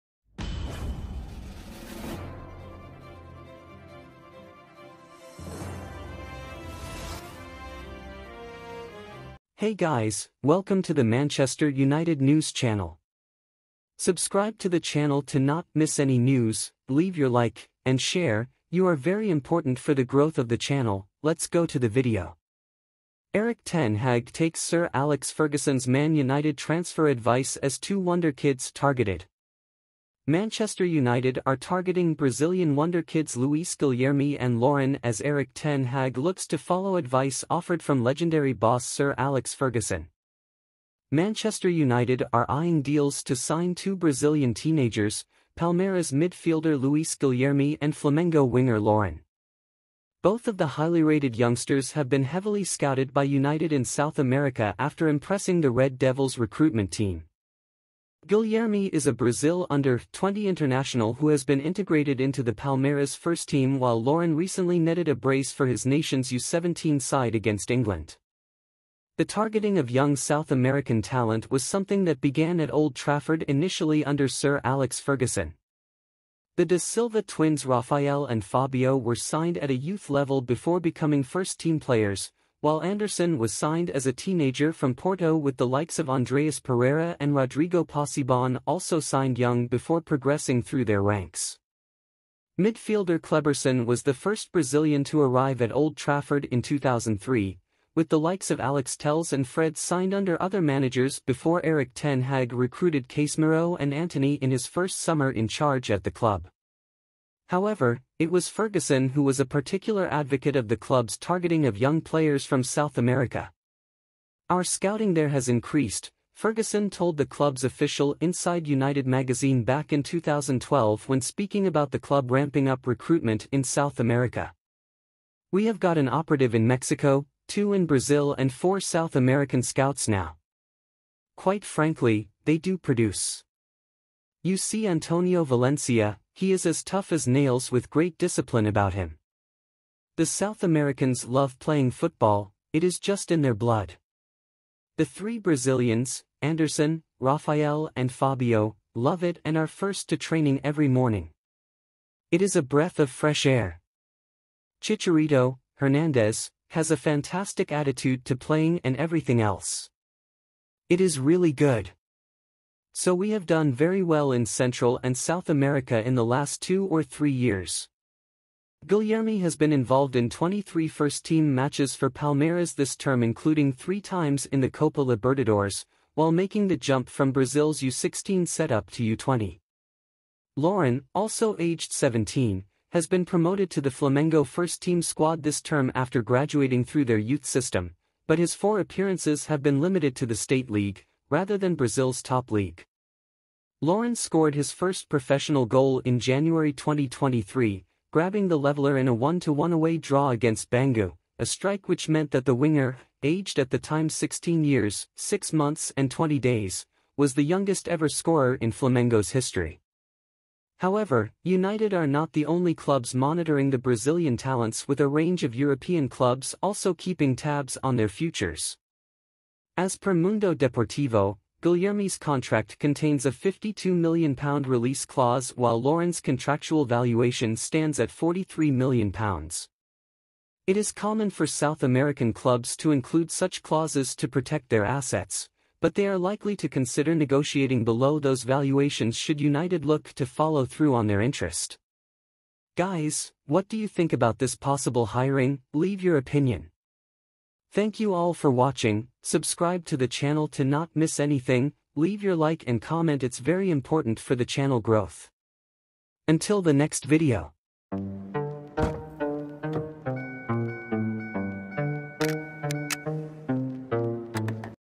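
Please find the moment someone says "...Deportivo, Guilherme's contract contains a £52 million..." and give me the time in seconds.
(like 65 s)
220 s.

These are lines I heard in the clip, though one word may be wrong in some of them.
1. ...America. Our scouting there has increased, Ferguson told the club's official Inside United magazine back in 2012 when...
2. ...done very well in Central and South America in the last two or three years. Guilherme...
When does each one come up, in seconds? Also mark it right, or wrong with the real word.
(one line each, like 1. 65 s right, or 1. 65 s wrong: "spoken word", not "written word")
1. 112 s right
2. 163 s right.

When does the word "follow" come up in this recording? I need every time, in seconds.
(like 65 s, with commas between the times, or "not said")
36 s, 240 s.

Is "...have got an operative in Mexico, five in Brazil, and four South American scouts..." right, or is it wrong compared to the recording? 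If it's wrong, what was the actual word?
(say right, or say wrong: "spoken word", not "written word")
wrong: "two", not "five".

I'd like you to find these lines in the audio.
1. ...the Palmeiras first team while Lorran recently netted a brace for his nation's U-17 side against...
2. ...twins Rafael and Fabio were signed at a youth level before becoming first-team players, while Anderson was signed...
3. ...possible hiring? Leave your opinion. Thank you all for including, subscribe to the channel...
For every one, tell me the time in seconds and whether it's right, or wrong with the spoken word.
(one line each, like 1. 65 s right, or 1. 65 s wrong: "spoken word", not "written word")
1. 62 s right
2. 77 s right
3. 244 s wrong: "watching", not "including".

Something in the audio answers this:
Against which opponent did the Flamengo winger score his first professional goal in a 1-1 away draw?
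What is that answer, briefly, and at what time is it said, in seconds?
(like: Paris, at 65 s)
Bangu, at 200 s.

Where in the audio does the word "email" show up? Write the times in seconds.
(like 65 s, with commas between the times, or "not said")
not said.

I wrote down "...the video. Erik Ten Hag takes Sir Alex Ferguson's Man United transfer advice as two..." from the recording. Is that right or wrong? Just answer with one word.
right.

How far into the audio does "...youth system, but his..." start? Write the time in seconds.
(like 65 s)
187 s.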